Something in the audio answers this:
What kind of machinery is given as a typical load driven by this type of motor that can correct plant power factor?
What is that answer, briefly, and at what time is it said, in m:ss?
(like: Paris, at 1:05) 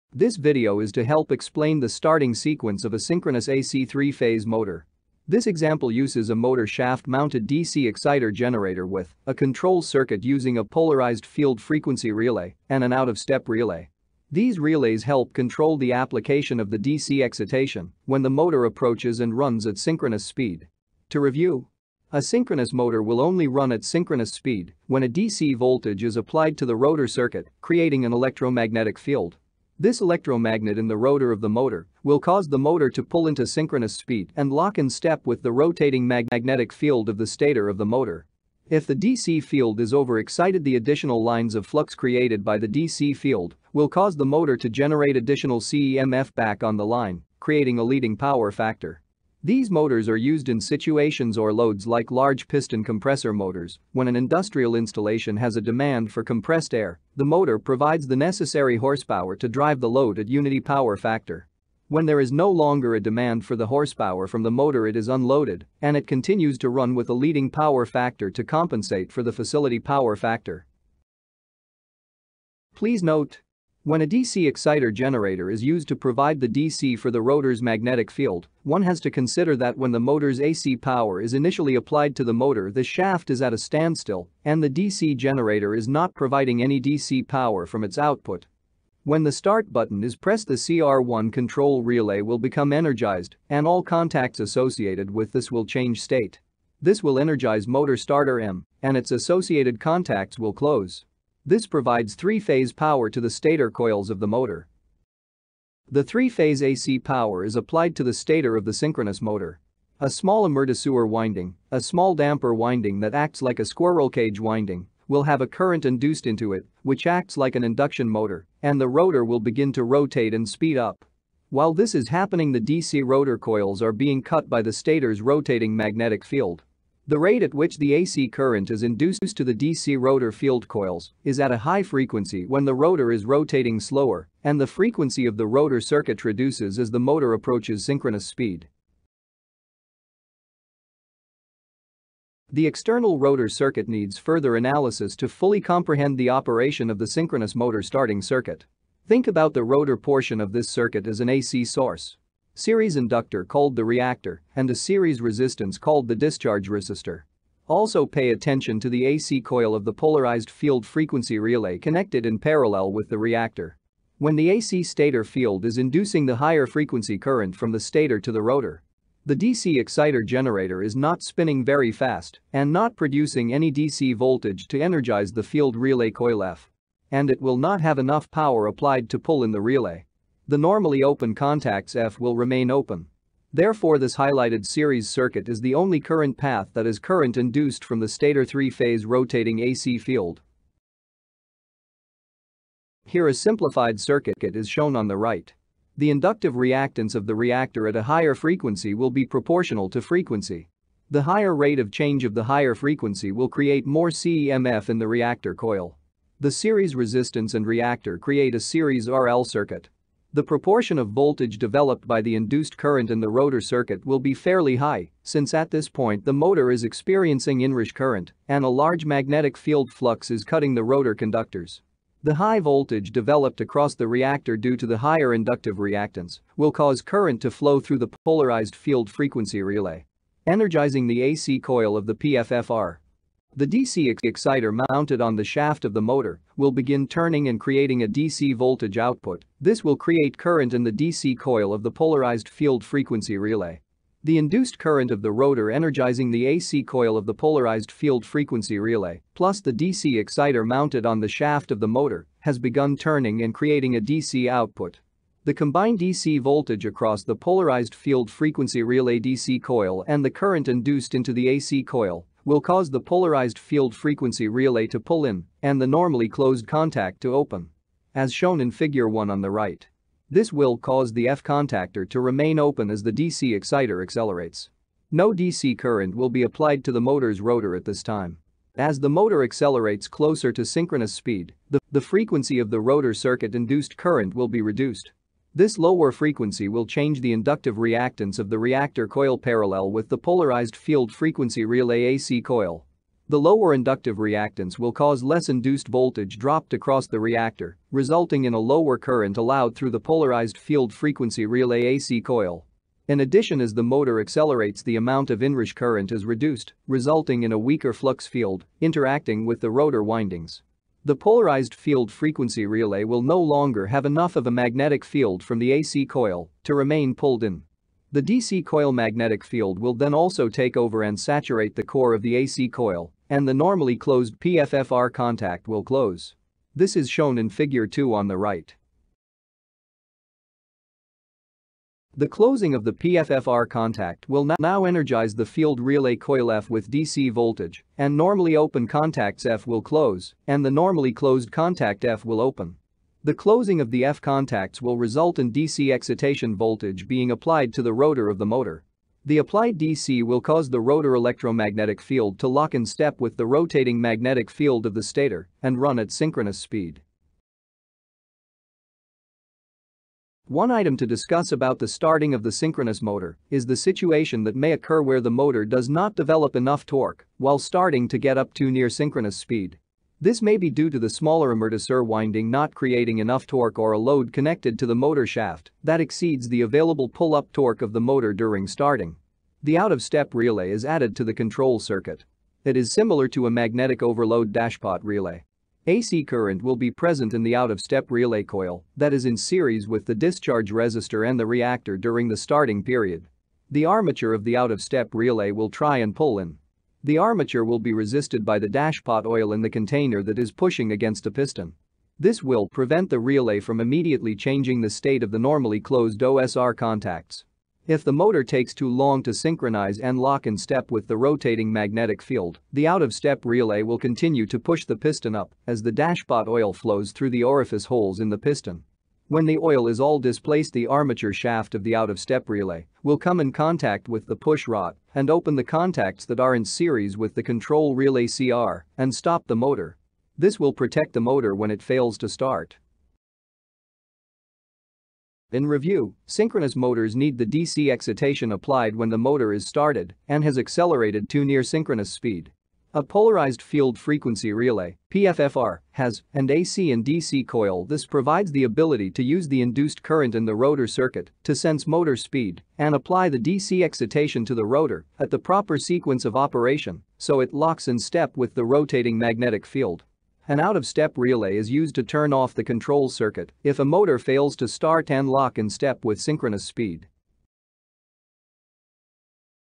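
Large piston compressor motors, at 0:52.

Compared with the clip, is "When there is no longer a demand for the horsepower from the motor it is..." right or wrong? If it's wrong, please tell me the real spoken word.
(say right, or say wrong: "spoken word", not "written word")
right.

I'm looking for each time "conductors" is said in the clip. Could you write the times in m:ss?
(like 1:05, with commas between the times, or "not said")
3:41.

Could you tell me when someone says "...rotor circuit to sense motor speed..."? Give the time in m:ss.
7:30.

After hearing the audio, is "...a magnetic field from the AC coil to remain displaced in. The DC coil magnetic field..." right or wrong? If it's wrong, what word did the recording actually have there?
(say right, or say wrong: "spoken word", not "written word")
wrong: "pulled", not "displaced".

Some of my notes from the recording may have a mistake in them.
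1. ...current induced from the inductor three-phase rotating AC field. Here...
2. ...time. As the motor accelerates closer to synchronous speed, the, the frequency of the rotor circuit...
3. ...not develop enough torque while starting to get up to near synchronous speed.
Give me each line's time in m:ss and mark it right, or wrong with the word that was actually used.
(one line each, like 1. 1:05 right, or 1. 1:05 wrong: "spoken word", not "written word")
1. 3:06 wrong: "stator", not "inductor"
2. 4:38 right
3. 6:05 right.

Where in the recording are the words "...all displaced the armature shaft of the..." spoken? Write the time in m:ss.
6:59.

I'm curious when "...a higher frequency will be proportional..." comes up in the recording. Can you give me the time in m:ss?
3:17.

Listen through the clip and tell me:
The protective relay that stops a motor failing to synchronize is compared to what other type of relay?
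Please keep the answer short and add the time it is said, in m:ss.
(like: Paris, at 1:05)
Magnetic overload dashpot relay, at 6:23.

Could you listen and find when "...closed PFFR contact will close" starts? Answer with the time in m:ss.
5:23.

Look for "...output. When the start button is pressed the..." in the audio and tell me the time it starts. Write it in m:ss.
1:27.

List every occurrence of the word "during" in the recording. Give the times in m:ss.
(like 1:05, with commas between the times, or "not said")
6:18, 6:31.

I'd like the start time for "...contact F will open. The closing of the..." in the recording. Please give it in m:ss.
5:41.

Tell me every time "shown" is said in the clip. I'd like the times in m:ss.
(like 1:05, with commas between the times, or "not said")
3:14, 4:28, 5:27.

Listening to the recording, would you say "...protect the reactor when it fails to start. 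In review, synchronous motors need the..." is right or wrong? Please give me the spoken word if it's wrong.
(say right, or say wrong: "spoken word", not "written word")
wrong: "motor", not "reactor".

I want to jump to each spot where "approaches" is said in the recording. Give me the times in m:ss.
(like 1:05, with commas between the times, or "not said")
0:18, 2:17.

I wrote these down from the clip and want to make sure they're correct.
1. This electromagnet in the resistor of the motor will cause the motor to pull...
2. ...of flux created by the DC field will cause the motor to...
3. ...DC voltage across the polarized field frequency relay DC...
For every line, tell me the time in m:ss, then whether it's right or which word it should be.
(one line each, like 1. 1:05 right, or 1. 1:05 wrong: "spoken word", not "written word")
1. 0:29 wrong: "rotor", not "resistor"
2. 0:41 right
3. 4:15 right.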